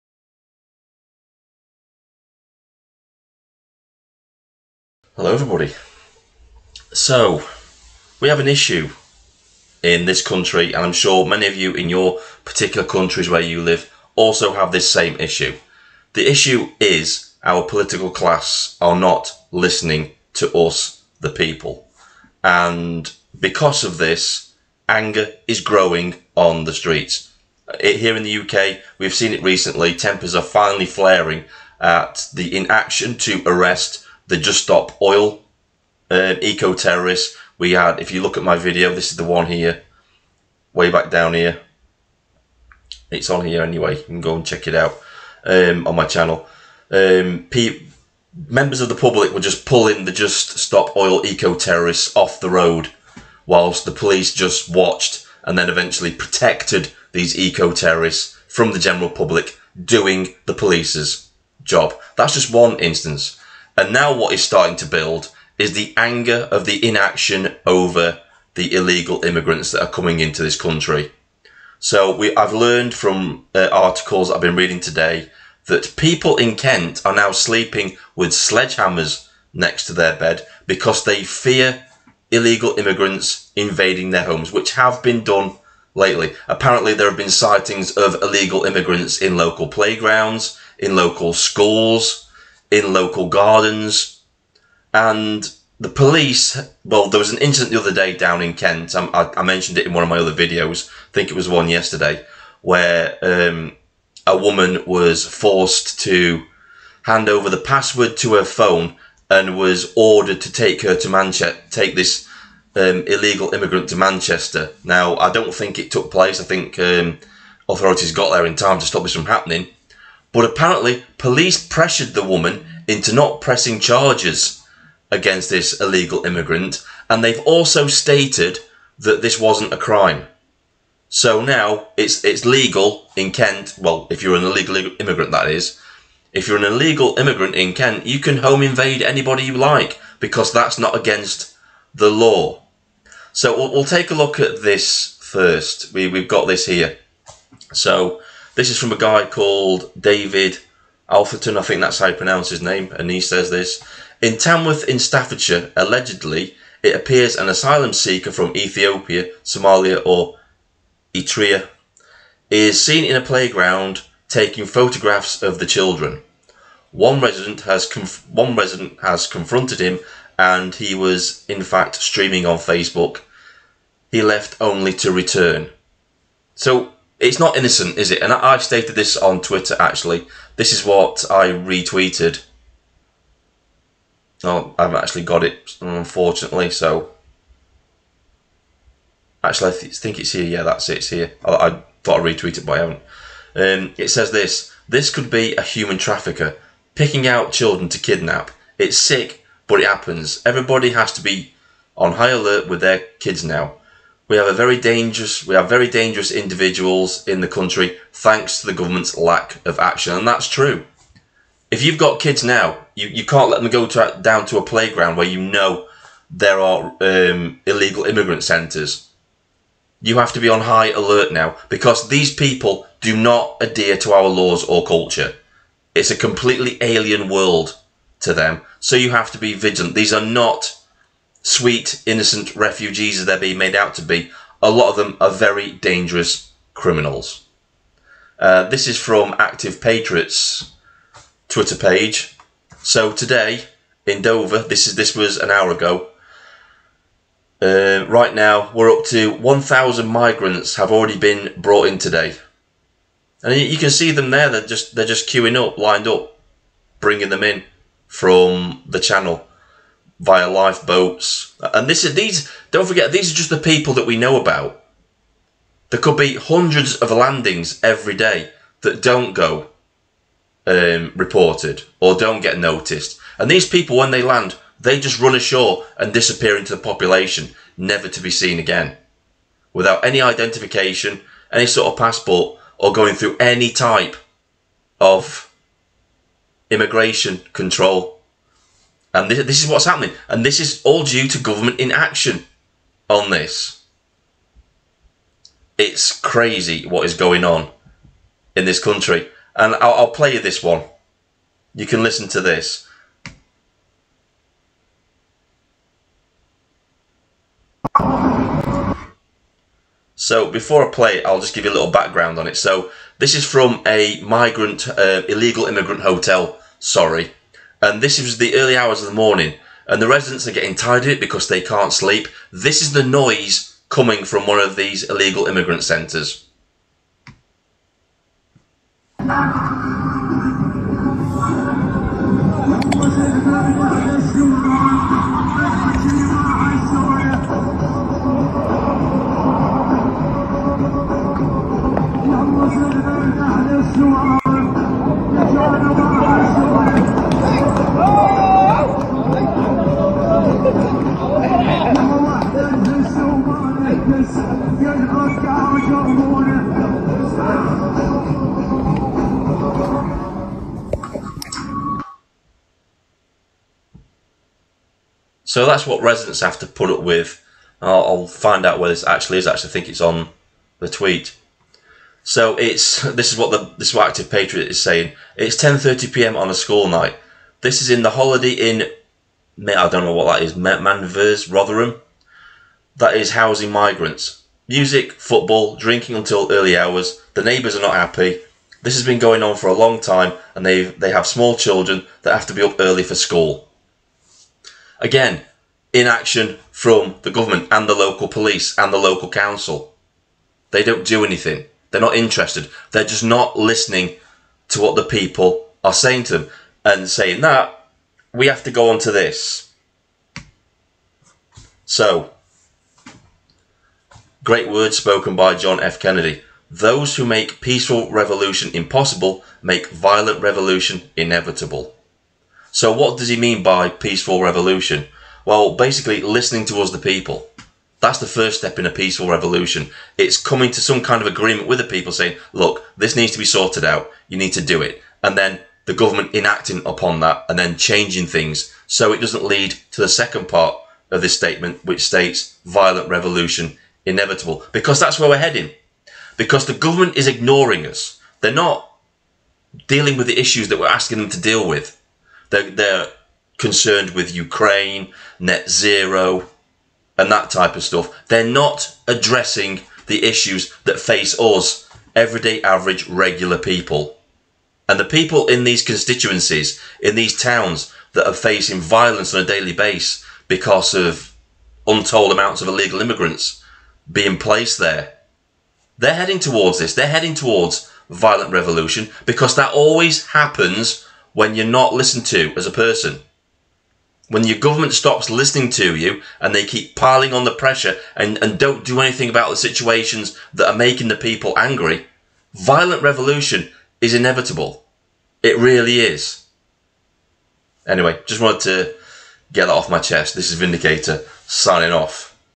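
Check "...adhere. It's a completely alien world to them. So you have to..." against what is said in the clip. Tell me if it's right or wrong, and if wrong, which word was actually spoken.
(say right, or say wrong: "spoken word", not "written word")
wrong: "culture", not "adhere".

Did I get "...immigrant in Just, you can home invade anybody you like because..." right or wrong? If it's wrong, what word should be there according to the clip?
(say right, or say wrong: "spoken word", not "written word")
wrong: "Kent", not "Just".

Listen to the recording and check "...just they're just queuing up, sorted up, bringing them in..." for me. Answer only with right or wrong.
wrong.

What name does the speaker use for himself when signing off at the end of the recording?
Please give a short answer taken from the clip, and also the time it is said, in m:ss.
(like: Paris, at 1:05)
Vindicator, at 8:20.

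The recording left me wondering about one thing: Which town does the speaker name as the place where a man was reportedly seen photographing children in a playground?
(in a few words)
Tamworth.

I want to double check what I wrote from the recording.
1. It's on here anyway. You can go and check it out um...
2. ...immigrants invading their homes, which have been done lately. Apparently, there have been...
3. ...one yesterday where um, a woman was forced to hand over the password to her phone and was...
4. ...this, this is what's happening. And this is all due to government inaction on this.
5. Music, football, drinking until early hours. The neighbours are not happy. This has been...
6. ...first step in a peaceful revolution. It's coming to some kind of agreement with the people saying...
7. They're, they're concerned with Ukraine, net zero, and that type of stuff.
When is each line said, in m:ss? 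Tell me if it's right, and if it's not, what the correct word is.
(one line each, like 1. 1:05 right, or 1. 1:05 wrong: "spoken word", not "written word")
1. 0:43 right
2. 1:22 right
3. 1:41 right
4. 4:49 right
5. 6:24 right
6. 7:08 right
7. 7:32 right.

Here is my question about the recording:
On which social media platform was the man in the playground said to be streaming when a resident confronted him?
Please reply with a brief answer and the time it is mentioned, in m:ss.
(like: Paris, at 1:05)
Facebook, at 2:52.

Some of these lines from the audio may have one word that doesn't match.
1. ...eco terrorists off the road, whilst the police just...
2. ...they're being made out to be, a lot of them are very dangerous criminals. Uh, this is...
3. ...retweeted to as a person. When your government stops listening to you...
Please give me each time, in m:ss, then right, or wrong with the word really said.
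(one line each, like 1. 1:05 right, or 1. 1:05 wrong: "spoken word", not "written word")
1. 0:51 right
2. 3:53 right
3. 8:01 wrong: "listened", not "retweeted".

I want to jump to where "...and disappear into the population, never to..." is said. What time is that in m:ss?
4:35.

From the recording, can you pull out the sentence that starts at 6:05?
So that's what residents have to put up with.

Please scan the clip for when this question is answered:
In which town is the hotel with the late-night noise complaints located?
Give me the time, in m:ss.
6:21.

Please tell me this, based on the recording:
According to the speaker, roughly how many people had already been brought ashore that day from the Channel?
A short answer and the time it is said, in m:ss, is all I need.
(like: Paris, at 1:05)
1,000, at 4:09.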